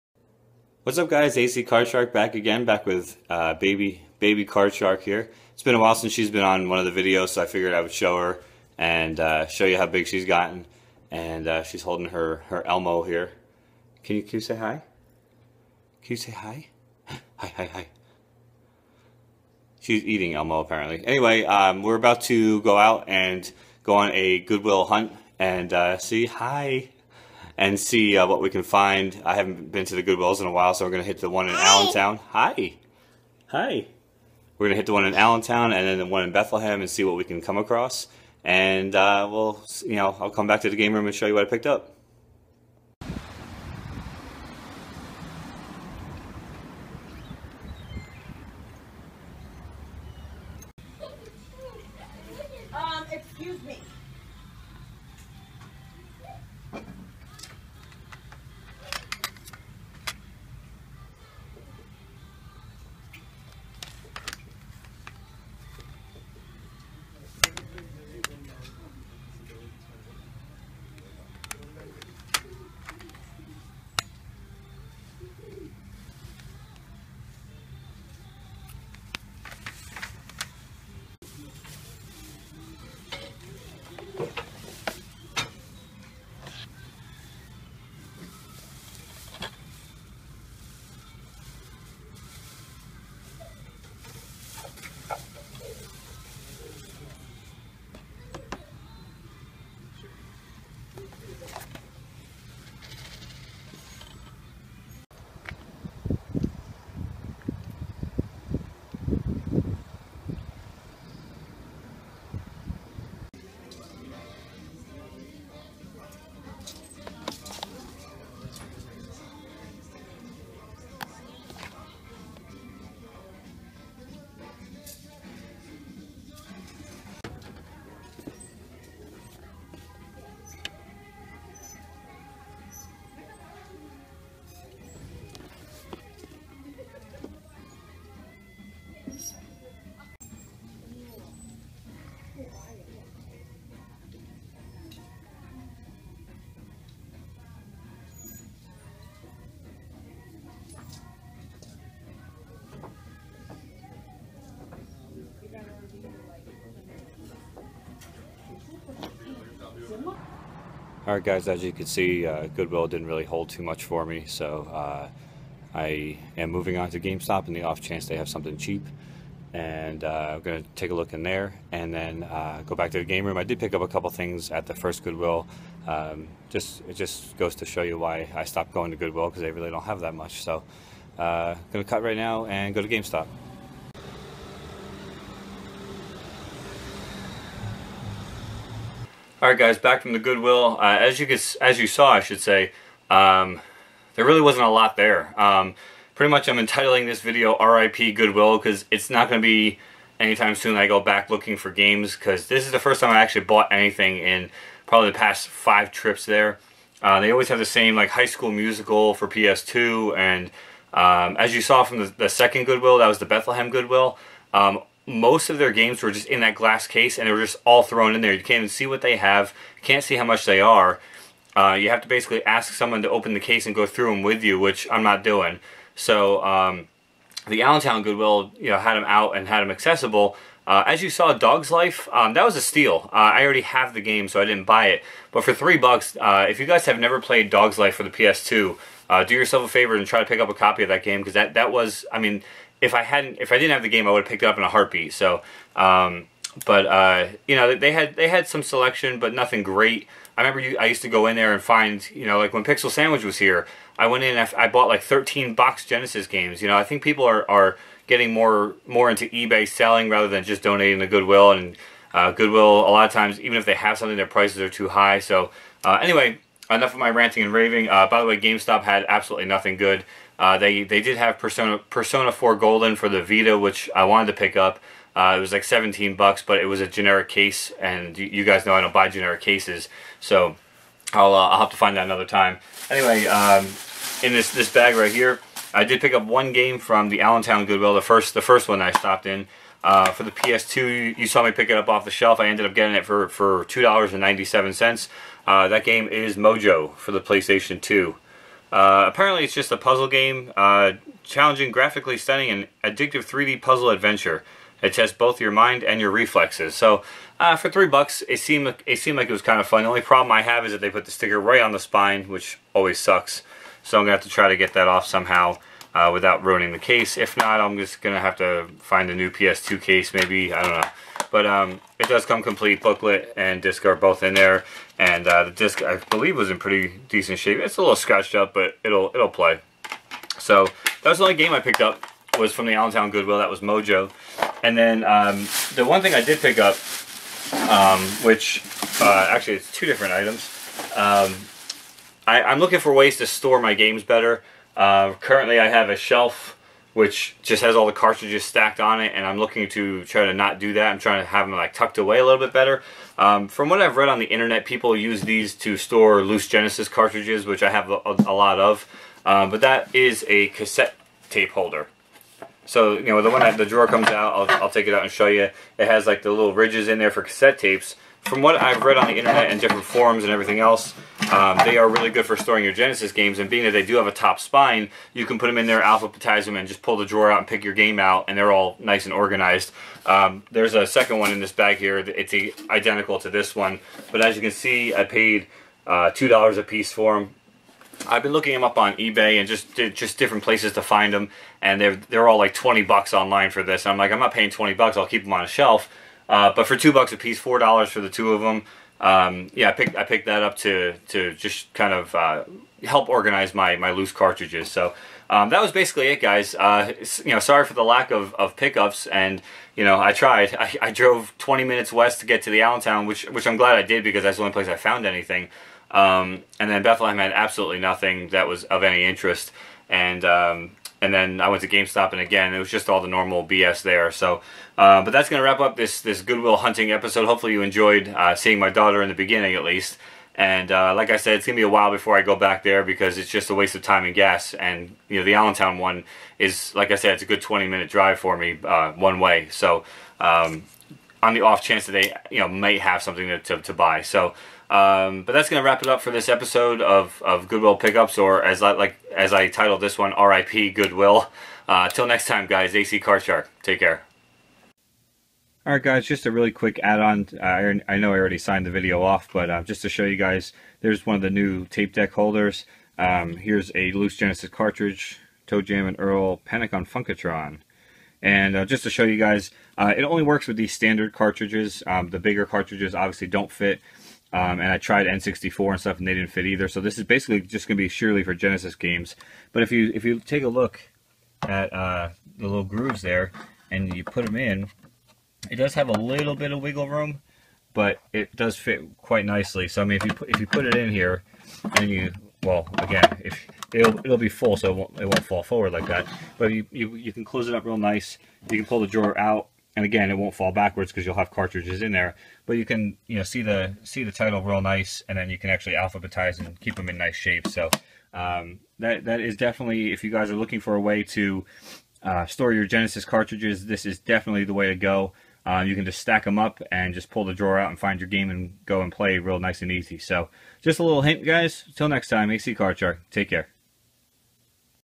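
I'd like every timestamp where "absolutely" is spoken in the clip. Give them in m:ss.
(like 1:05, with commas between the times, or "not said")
4:29, 6:57.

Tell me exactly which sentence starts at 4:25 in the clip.
So uh, anyway, enough of my ranting and raving.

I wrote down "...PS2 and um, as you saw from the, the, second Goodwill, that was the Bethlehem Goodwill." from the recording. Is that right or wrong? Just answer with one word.
right.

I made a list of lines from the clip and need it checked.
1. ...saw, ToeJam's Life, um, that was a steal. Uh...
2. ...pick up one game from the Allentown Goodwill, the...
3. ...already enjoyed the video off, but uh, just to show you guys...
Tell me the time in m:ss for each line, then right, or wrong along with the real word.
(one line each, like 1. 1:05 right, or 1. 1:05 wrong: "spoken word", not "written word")
1. 3:51 wrong: "Dog", not "ToeJam"
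2. 4:46 right
3. 7:38 wrong: "signed", not "enjoyed".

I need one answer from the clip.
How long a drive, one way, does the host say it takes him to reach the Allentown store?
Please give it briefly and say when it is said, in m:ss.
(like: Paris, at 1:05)
20 minutes, at 6:51.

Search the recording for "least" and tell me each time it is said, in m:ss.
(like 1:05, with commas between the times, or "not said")
7:09.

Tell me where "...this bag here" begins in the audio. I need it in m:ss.
6:21.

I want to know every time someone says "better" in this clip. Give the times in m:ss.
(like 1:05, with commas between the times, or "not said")
5:44, 5:52.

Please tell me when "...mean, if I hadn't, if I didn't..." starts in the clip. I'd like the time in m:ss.
4:02.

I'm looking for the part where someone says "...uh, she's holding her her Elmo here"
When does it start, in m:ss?
0:11.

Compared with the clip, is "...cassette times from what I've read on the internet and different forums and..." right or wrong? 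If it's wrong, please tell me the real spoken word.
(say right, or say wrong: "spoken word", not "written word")
wrong: "tapes", not "times".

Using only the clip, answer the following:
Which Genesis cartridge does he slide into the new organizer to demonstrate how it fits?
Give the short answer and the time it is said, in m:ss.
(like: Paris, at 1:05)
ToeJam and Earl Panic on Funkotron, at 7:45.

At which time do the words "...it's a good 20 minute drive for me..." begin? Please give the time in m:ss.
7:17.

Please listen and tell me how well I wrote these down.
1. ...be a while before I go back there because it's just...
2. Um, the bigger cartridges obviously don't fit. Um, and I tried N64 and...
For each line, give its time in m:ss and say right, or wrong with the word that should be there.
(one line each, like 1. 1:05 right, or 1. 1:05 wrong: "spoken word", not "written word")
1. 7:11 right
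2. 7:51 right.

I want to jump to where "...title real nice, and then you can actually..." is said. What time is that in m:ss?
8:24.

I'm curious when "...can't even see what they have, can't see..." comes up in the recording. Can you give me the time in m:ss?
3:38.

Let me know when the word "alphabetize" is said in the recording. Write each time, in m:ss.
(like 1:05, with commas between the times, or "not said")
6:15, 8:25.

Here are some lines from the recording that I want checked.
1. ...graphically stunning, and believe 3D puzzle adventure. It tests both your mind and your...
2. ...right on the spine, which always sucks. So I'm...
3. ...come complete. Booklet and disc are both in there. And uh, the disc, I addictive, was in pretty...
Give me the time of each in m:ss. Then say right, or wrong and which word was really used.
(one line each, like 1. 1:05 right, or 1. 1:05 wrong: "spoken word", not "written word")
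1. 5:01 wrong: "addictive", not "believe"
2. 5:11 right
3. 5:22 wrong: "believe", not "addictive".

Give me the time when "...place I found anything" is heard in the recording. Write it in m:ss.
6:54.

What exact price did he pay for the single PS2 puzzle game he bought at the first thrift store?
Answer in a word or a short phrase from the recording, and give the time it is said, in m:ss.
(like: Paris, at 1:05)
$2.97, at 4:53.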